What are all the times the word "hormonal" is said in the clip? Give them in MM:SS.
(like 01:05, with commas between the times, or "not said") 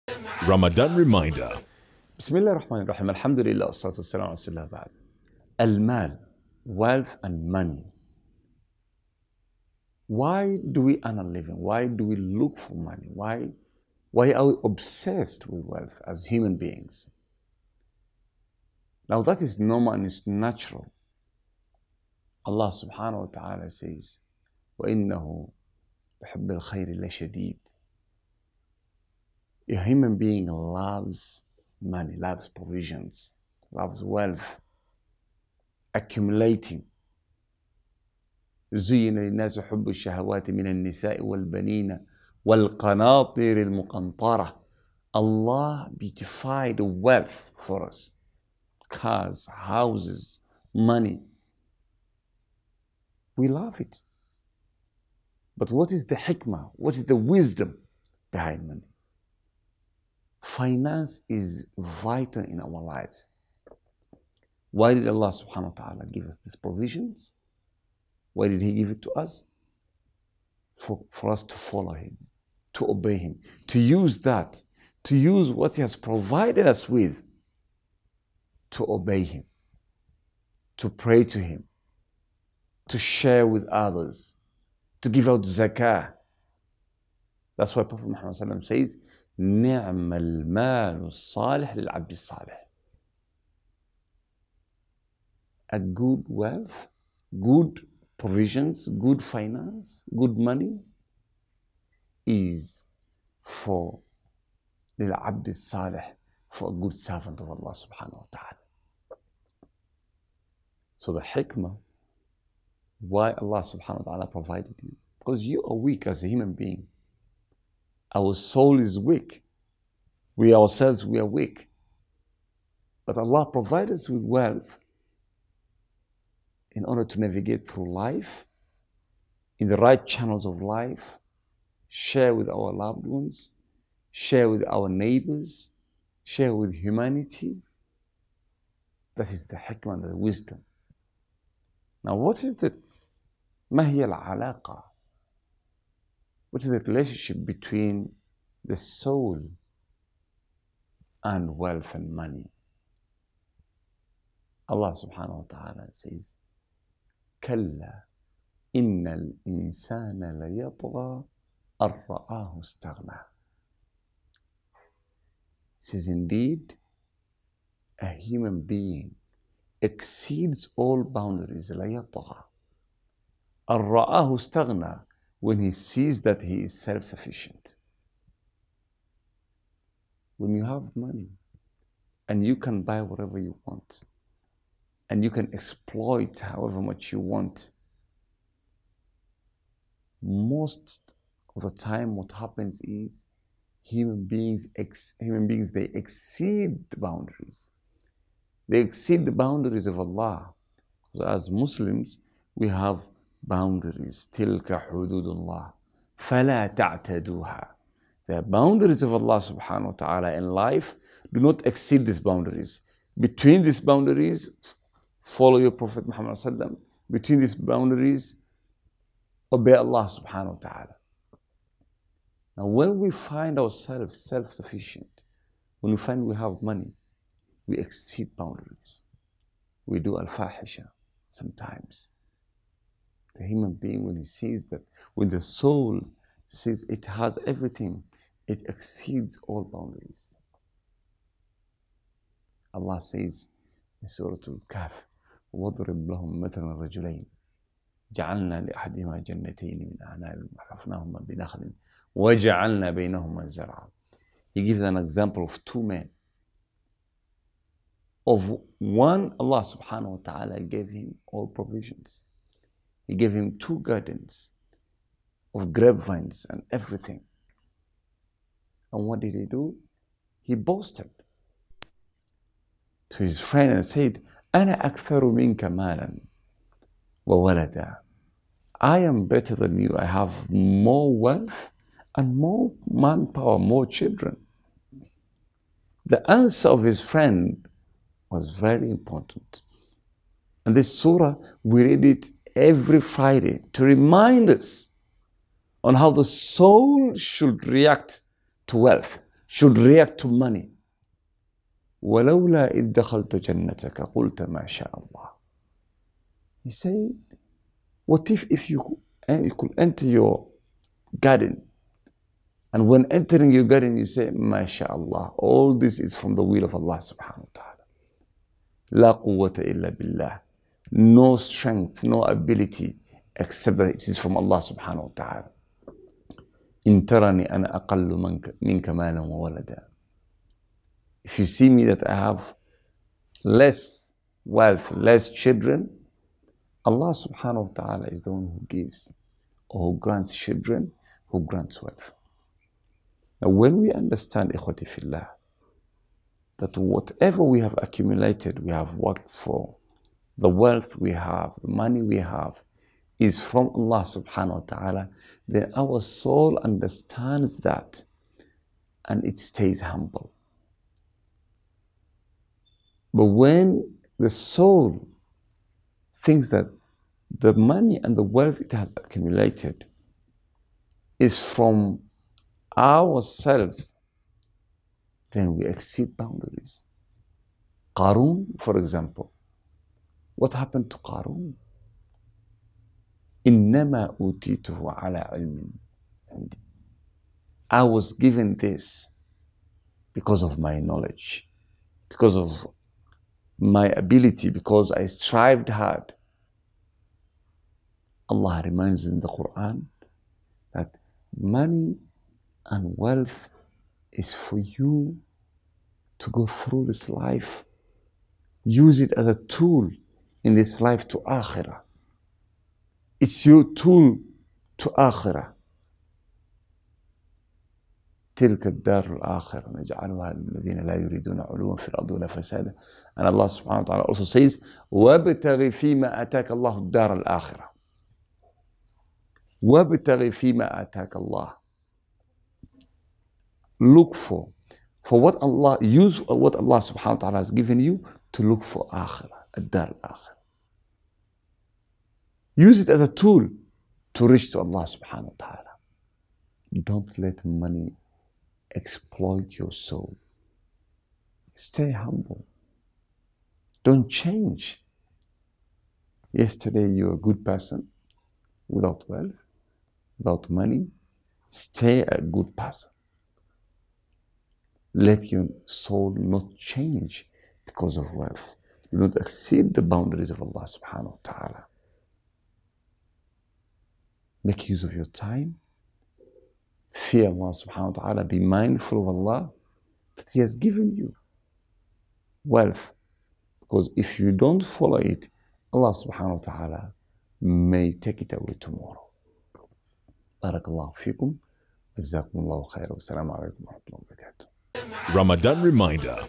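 not said.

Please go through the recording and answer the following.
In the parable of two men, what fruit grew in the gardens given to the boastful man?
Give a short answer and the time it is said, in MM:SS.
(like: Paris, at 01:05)
Grapevines, at 04:25.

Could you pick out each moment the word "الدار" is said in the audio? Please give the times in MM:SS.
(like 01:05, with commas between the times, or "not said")
06:58, 07:06, 07:19.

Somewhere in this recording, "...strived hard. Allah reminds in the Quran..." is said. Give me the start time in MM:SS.
06:35.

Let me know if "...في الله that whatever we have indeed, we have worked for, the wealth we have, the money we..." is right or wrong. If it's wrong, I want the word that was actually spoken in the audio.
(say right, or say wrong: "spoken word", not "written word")
wrong: "accumulated", not "indeed".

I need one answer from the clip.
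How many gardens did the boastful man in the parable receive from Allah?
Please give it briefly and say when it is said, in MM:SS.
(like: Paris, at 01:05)
2, at 04:23.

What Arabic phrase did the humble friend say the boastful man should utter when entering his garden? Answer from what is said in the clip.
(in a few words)
MashaAllah.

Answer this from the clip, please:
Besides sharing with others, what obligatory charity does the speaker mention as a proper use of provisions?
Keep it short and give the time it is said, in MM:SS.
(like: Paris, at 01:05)
Zakah, at 01:25.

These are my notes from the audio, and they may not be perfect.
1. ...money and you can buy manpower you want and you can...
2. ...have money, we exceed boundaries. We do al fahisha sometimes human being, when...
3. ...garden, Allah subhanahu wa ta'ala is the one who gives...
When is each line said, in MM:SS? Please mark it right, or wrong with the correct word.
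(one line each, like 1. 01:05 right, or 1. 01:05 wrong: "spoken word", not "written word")
1. 03:00 wrong: "whatever", not "manpower"
2. 03:46 right
3. 05:35 wrong: "children", not "garden".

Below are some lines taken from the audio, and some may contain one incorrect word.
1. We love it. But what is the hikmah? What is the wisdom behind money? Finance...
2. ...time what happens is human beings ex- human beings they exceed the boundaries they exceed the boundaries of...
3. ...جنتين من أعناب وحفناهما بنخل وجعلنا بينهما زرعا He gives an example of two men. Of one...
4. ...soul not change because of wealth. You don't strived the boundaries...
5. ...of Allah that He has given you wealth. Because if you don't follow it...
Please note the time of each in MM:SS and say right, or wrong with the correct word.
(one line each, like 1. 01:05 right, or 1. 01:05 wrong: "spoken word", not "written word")
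1. 00:53 right
2. 03:11 right
3. 04:09 right
4. 07:45 wrong: "exceed", not "strived"
5. 07:59 right.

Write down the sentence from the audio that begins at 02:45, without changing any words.
Says indeed, a human being exceeds all boundaries ليطغى.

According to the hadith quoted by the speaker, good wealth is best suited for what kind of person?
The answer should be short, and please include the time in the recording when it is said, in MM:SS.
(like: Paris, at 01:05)
A good servant of Allah, at 01:46.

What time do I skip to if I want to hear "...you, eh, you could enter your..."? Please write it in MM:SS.
05:08.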